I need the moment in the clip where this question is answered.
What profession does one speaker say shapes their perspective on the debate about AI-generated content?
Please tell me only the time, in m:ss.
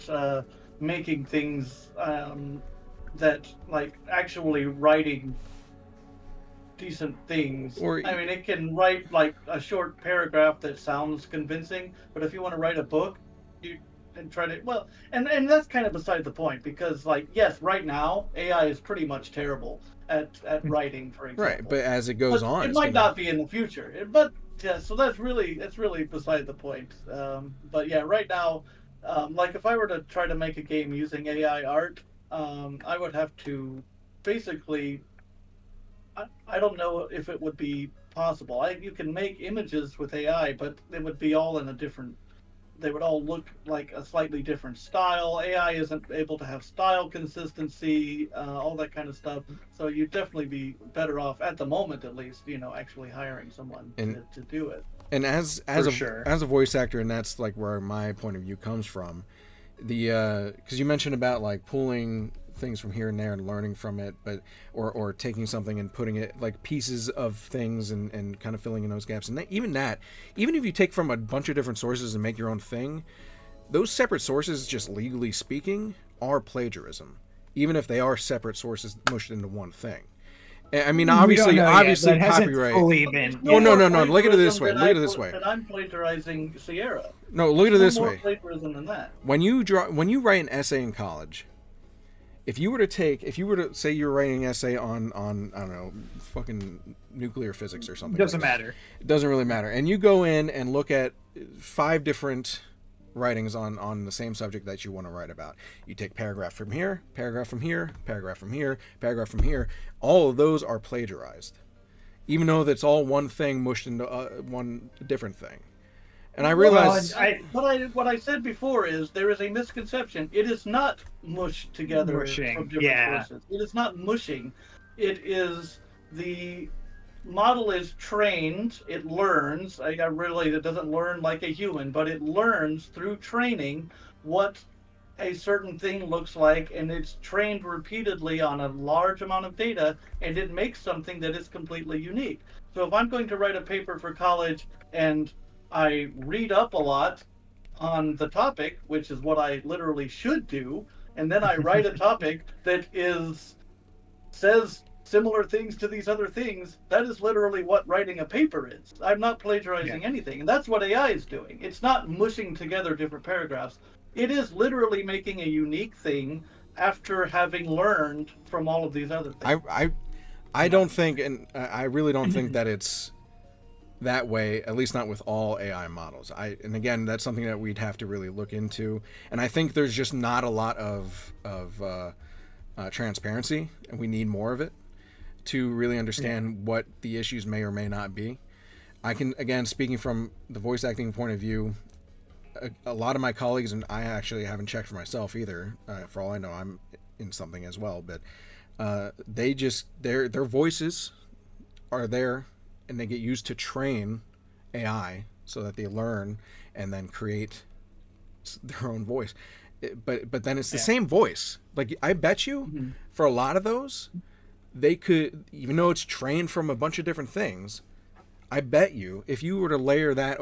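0:56.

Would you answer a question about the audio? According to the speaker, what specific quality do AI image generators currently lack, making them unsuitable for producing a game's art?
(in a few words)
Style consistency.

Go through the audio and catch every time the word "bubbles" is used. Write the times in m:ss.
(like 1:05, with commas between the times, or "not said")
not said.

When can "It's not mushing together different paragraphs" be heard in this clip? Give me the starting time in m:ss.
2:41.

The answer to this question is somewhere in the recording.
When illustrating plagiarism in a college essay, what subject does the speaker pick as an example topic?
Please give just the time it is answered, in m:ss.
1:37.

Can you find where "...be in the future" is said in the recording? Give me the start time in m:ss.
0:23.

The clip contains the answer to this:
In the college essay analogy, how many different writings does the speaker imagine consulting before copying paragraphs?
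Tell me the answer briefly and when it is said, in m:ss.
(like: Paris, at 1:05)
5, at 1:41.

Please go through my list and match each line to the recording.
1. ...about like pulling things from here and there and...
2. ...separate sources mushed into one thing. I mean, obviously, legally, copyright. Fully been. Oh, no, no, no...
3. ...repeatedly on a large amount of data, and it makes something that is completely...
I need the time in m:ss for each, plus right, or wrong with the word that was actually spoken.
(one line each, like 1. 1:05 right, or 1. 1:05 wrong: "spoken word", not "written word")
1. 1:01 right
2. 1:18 wrong: "obviously", not "legally"
3. 2:17 right.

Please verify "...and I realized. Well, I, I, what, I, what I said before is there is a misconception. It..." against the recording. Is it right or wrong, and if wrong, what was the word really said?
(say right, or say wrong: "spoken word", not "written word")
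right.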